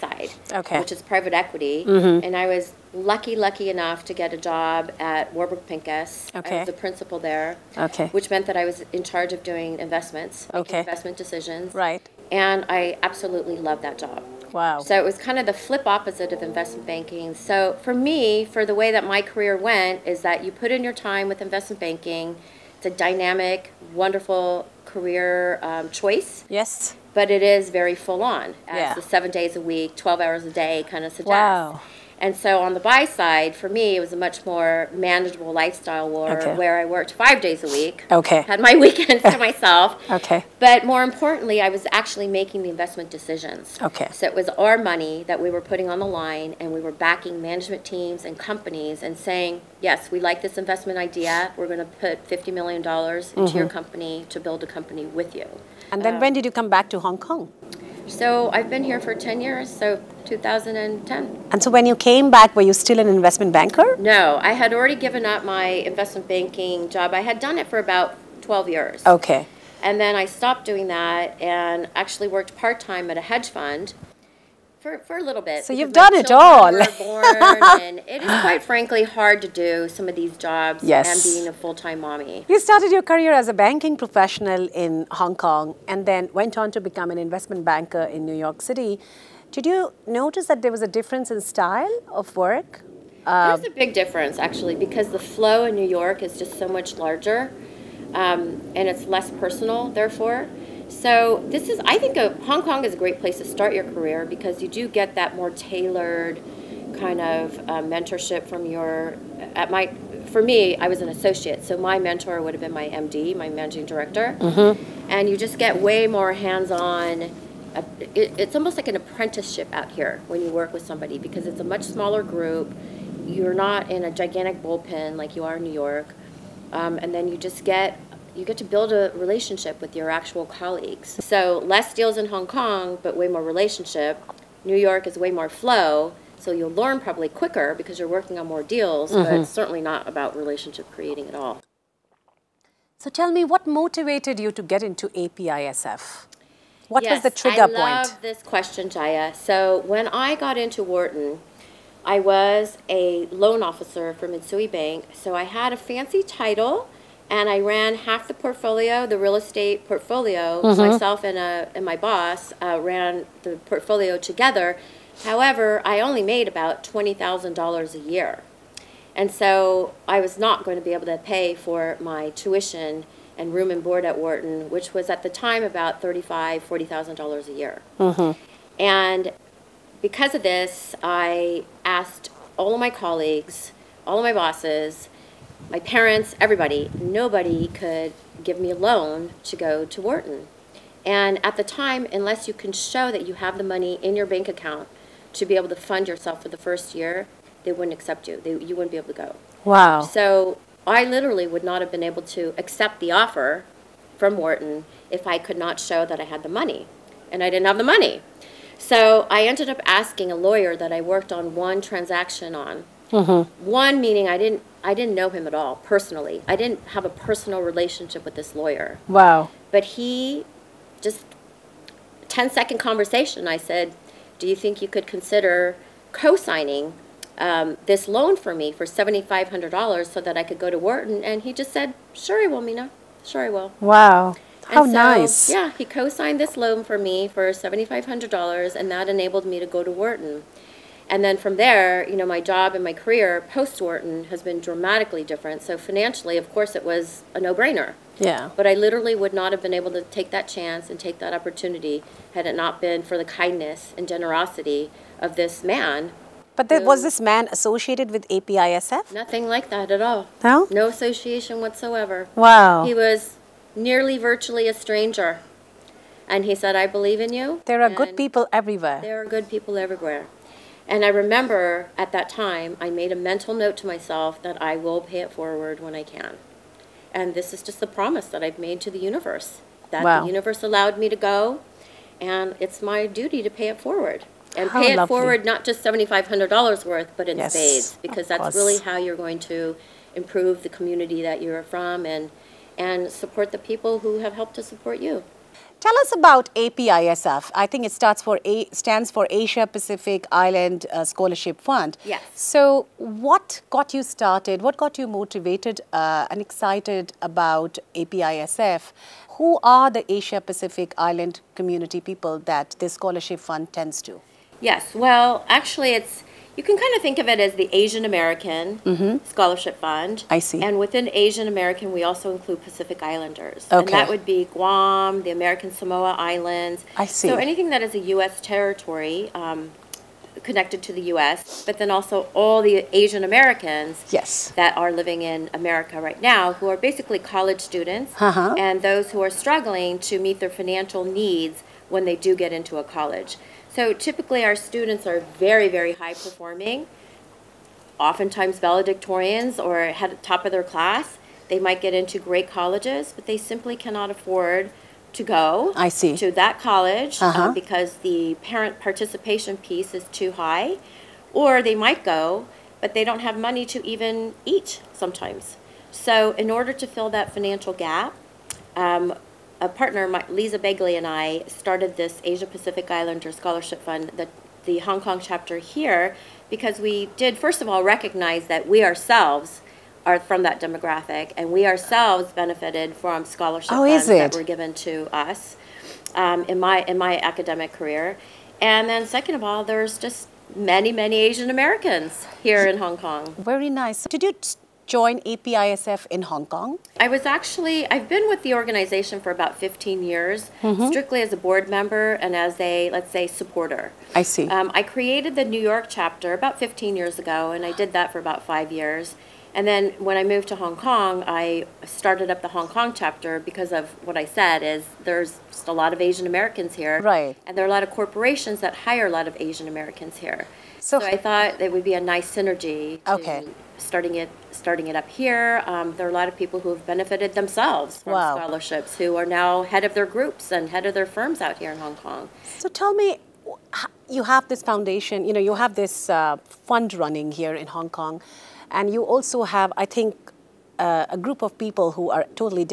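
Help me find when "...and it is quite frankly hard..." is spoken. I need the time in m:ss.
1:17.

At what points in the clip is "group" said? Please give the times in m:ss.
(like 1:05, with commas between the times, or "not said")
2:02, 7:10, 7:21.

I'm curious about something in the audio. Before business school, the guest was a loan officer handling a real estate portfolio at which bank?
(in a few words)
Mitsui Bank.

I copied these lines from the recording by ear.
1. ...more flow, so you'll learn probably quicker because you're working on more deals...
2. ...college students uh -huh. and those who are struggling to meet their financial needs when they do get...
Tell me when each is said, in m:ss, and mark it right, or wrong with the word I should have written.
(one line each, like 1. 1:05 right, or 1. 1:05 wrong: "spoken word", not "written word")
1. 2:15 right
2. 5:37 right.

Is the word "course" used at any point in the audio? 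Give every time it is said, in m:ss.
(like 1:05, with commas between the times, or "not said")
4:06, 4:48.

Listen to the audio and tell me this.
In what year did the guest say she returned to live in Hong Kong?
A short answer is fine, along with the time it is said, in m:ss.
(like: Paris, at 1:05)
2010, at 1:00.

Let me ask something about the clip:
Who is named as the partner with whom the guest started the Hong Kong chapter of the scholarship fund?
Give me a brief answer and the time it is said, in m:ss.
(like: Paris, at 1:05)
Lisa Begley, at 6:10.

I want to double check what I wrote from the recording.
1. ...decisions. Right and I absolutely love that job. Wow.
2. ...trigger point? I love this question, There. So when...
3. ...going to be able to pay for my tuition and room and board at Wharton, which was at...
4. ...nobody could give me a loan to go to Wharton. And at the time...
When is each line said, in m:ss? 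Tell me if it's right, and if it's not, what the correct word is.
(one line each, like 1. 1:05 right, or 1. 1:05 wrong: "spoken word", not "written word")
1. 0:11 right
2. 2:27 wrong: "Jaya", not "There"
3. 2:50 right
4. 3:06 right.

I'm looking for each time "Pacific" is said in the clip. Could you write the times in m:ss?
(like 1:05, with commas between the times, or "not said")
4:59, 5:10, 5:22, 6:12.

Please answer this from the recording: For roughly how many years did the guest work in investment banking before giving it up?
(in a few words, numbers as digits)
12 years.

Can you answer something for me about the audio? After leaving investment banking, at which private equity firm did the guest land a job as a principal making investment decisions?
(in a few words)
Warburg Pincus.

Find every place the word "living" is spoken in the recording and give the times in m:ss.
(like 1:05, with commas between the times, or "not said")
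5:35.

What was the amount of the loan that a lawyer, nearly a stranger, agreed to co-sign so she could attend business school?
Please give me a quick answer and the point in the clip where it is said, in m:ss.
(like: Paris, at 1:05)
$7,500, at 3:48.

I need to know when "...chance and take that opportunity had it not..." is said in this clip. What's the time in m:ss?
4:10.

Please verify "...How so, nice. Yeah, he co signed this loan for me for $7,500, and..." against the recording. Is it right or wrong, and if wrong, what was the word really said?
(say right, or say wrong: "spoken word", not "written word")
right.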